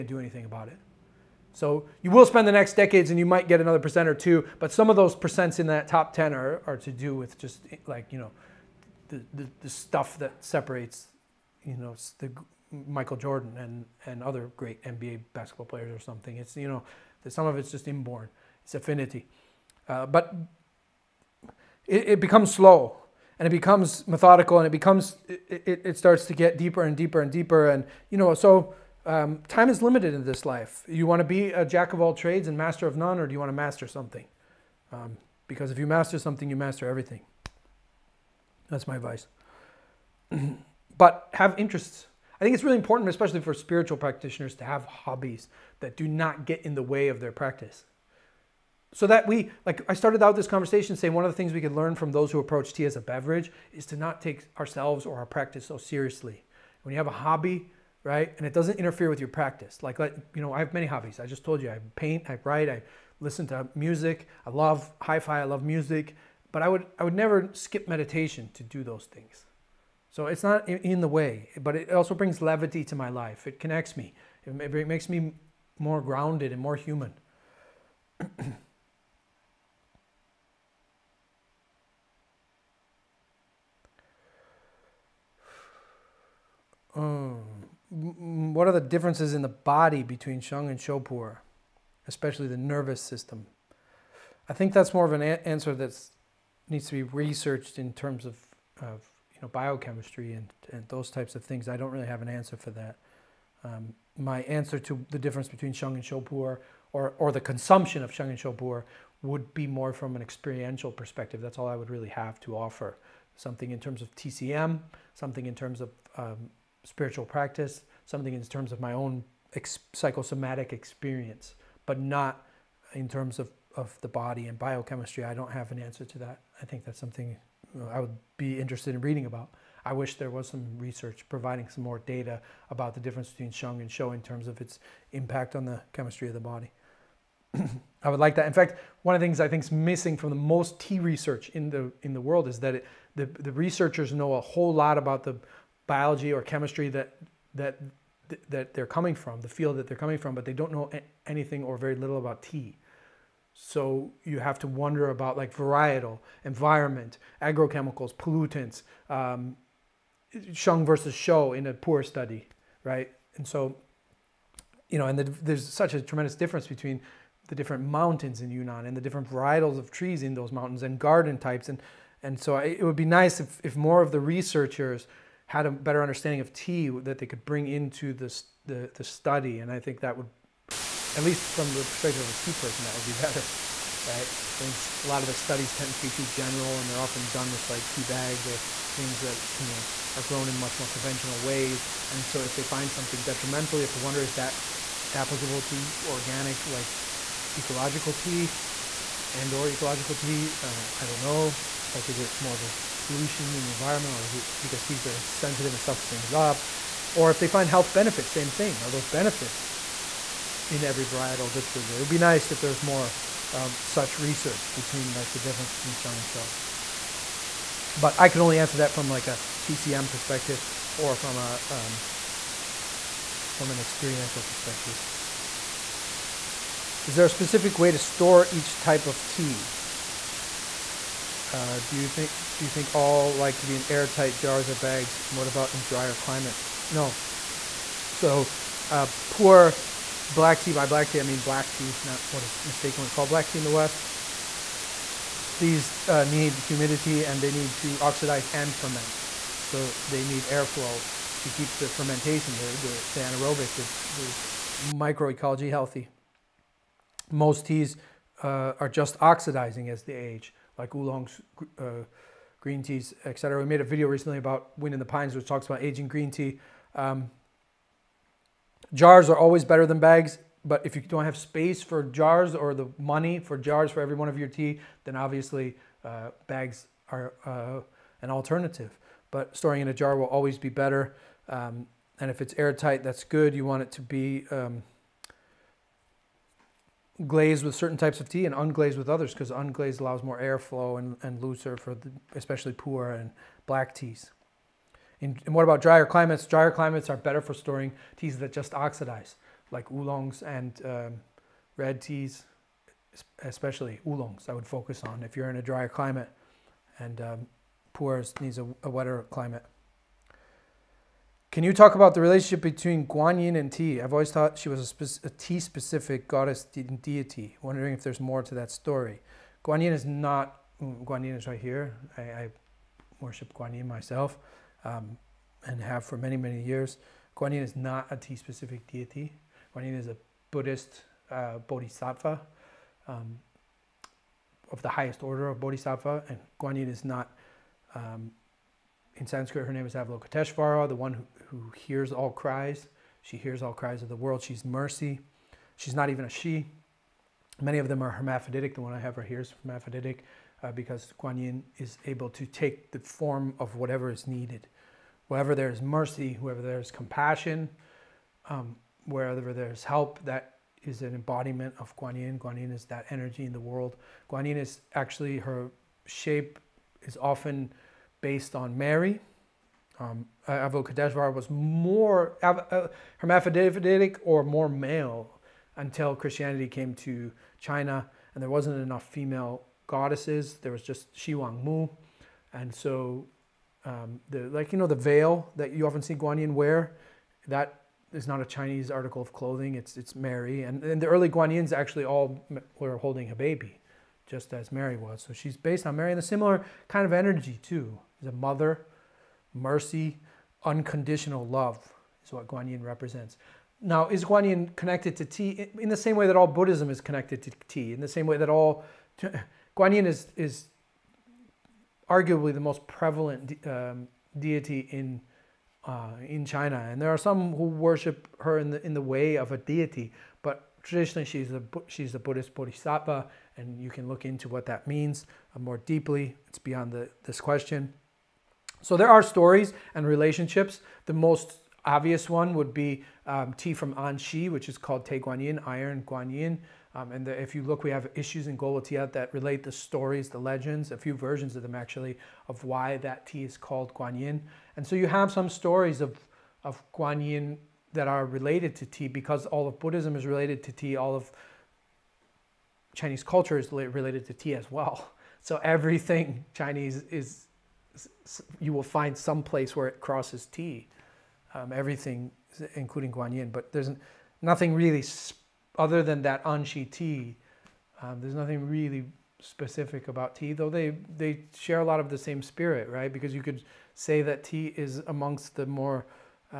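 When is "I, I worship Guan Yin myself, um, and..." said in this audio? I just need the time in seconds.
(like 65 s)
322 s.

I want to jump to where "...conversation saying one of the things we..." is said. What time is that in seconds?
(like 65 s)
50 s.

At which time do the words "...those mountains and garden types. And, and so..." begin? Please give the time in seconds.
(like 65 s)
170 s.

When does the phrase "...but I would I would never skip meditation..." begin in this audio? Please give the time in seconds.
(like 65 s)
66 s.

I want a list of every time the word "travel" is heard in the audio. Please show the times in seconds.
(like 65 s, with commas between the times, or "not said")
not said.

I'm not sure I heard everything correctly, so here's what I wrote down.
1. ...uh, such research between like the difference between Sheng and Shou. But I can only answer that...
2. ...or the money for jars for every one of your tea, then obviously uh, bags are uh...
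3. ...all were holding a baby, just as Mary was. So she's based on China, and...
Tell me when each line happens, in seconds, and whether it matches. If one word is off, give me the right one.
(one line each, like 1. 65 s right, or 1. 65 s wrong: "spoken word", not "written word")
1. 213 s right
2. 272 s right
3. 392 s wrong: "Mary", not "China".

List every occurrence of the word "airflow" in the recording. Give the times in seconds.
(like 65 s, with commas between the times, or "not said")
250 s, 290 s.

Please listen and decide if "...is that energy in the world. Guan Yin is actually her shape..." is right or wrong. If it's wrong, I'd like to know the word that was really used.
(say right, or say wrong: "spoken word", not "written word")
right.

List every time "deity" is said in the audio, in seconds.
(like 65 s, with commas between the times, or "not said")
316 s, 328 s, 414 s, 419 s.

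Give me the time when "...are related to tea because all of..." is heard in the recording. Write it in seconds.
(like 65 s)
448 s.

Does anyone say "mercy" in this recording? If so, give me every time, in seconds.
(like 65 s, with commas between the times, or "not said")
344 s, 355 s, 399 s.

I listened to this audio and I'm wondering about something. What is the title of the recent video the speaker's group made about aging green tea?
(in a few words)
Wind in the Pines.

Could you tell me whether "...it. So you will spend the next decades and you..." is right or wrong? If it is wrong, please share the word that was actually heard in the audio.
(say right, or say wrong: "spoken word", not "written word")
right.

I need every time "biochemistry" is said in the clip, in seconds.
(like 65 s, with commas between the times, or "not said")
99 s, 124 s.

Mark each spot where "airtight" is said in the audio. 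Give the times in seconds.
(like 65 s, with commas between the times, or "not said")
233 s, 282 s.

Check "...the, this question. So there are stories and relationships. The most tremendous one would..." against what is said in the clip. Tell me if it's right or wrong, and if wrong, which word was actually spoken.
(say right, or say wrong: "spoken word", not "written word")
wrong: "obvious", not "tremendous".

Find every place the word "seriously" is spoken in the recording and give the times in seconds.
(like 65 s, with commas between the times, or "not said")
55 s.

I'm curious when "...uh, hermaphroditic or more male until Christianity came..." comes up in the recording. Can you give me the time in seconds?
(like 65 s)
372 s.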